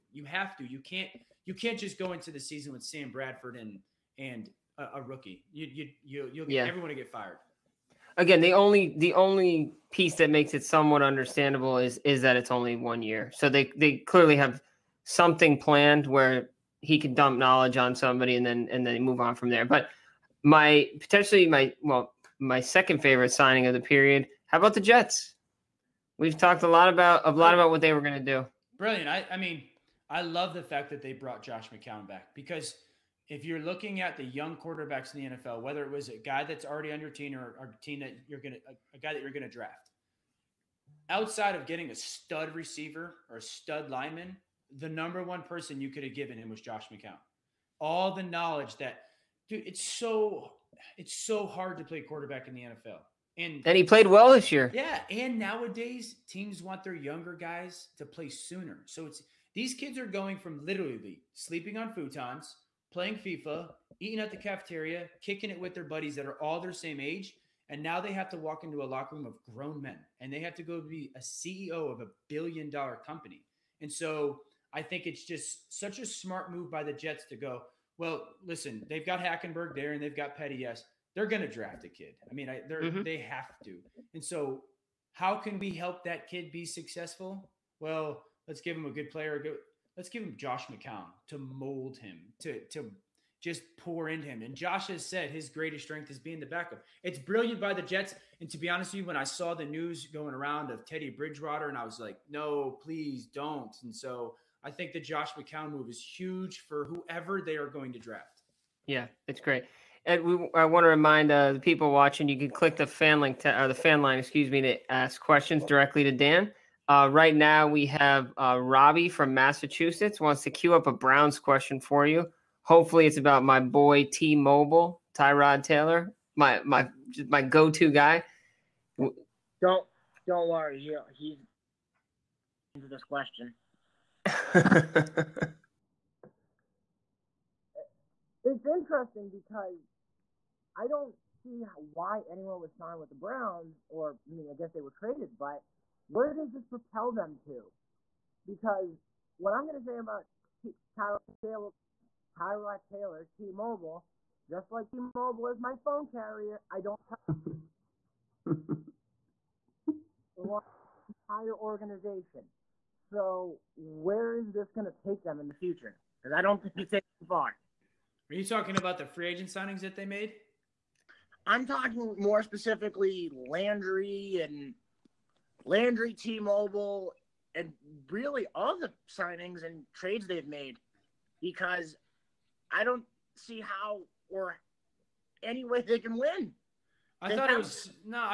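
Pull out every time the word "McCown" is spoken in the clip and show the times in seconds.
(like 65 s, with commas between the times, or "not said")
31 s, 46 s, 90 s, 105 s.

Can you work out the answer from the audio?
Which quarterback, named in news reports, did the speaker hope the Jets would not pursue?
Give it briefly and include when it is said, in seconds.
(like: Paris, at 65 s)
Teddy Bridgewater, at 100 s.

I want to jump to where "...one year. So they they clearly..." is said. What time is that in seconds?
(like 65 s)
12 s.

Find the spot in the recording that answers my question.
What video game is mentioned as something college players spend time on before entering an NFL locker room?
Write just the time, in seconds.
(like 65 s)
63 s.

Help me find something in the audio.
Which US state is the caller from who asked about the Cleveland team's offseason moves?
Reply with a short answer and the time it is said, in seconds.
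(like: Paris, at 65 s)
Massachusetts, at 119 s.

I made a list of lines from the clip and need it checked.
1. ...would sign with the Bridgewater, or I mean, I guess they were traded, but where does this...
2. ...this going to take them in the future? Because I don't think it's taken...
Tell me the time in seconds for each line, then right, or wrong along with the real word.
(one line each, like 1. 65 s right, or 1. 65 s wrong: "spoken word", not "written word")
1. 142 s wrong: "Browns", not "Bridgewater"
2. 164 s right.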